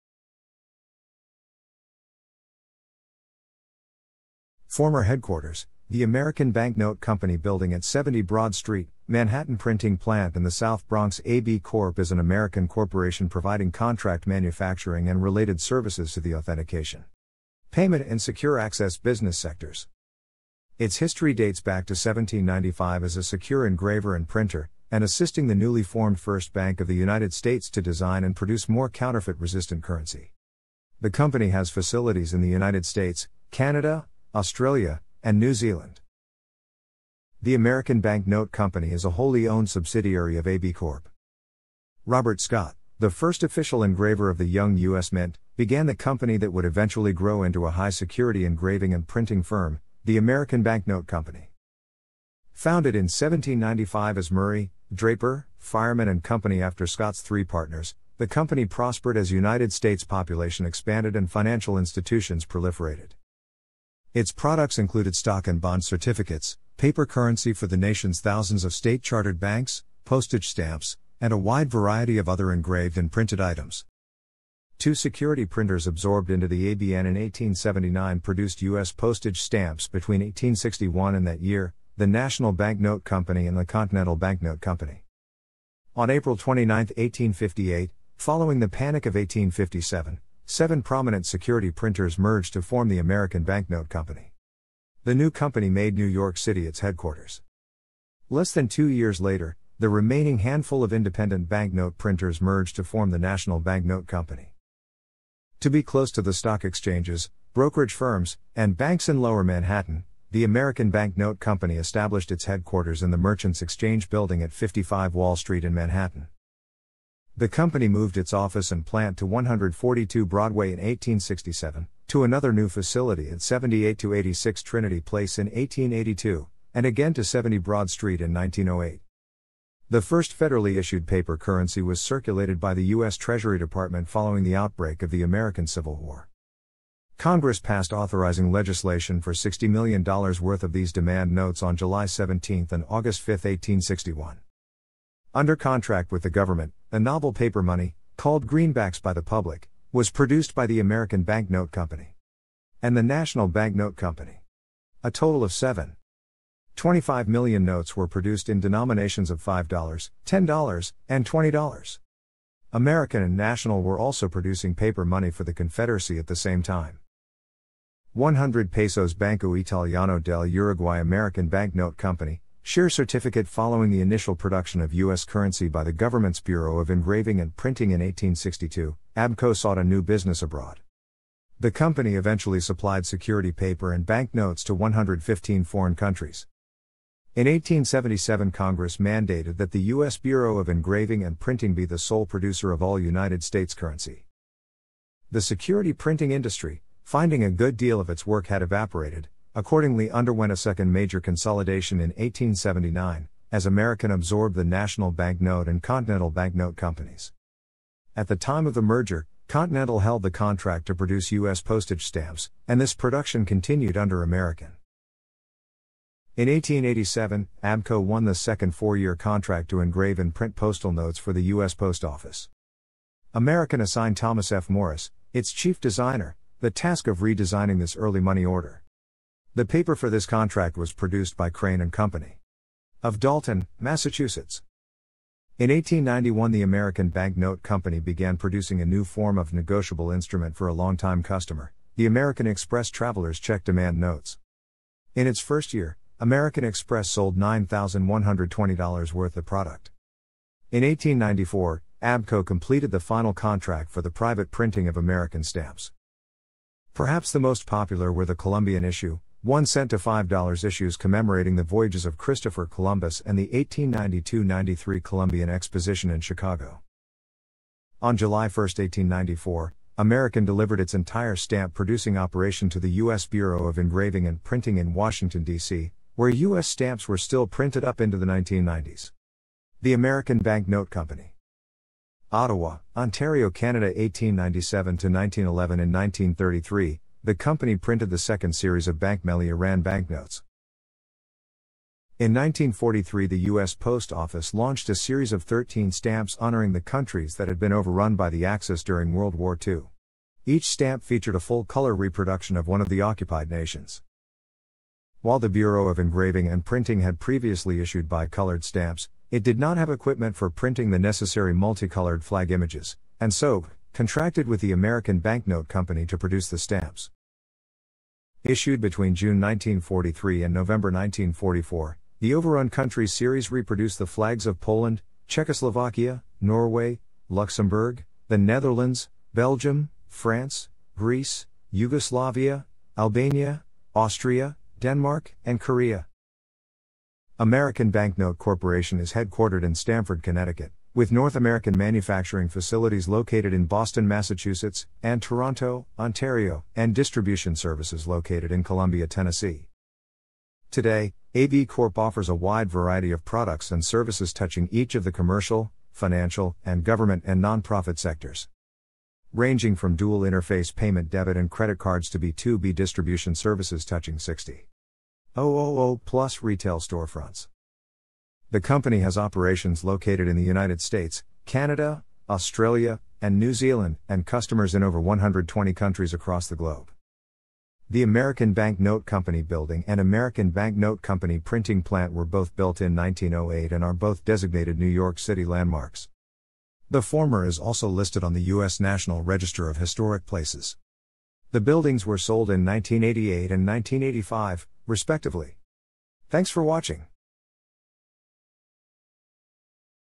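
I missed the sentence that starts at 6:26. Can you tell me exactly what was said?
The former is also listed on the U.S.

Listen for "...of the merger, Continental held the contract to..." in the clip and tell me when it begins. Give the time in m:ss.
3:28.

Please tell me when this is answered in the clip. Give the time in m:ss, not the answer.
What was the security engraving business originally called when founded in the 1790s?
0:54.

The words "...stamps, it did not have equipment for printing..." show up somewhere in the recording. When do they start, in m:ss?
5:08.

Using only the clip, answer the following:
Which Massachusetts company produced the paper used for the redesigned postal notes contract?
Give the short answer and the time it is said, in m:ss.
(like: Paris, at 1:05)
Crane and Company, at 3:51.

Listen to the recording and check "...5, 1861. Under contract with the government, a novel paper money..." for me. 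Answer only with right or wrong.
right.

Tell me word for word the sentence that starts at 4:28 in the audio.
On July 1, 1894, American delivered its entire stamp producing operation to the U.S.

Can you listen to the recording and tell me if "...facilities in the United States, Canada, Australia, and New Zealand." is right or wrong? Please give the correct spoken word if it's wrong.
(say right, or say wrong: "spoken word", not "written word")
right.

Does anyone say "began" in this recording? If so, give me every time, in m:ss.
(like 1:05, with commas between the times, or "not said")
0:45, 3:57.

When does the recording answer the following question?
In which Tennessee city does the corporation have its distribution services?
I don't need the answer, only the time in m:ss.
5:48.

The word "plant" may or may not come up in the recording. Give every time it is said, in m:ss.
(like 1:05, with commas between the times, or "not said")
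0:09, 1:58, 6:21.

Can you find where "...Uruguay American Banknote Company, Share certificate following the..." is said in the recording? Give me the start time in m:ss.
2:50.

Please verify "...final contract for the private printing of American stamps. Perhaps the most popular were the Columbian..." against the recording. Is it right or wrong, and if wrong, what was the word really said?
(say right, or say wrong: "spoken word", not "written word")
right.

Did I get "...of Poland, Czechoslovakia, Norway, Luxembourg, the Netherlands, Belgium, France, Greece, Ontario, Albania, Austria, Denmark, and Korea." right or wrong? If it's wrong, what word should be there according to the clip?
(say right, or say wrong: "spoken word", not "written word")
wrong: "Yugoslavia", not "Ontario".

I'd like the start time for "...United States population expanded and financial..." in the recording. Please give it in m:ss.
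0:59.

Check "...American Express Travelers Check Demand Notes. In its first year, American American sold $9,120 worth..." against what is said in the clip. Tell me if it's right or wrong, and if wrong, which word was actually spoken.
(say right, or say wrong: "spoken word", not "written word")
wrong: "Express", not "American".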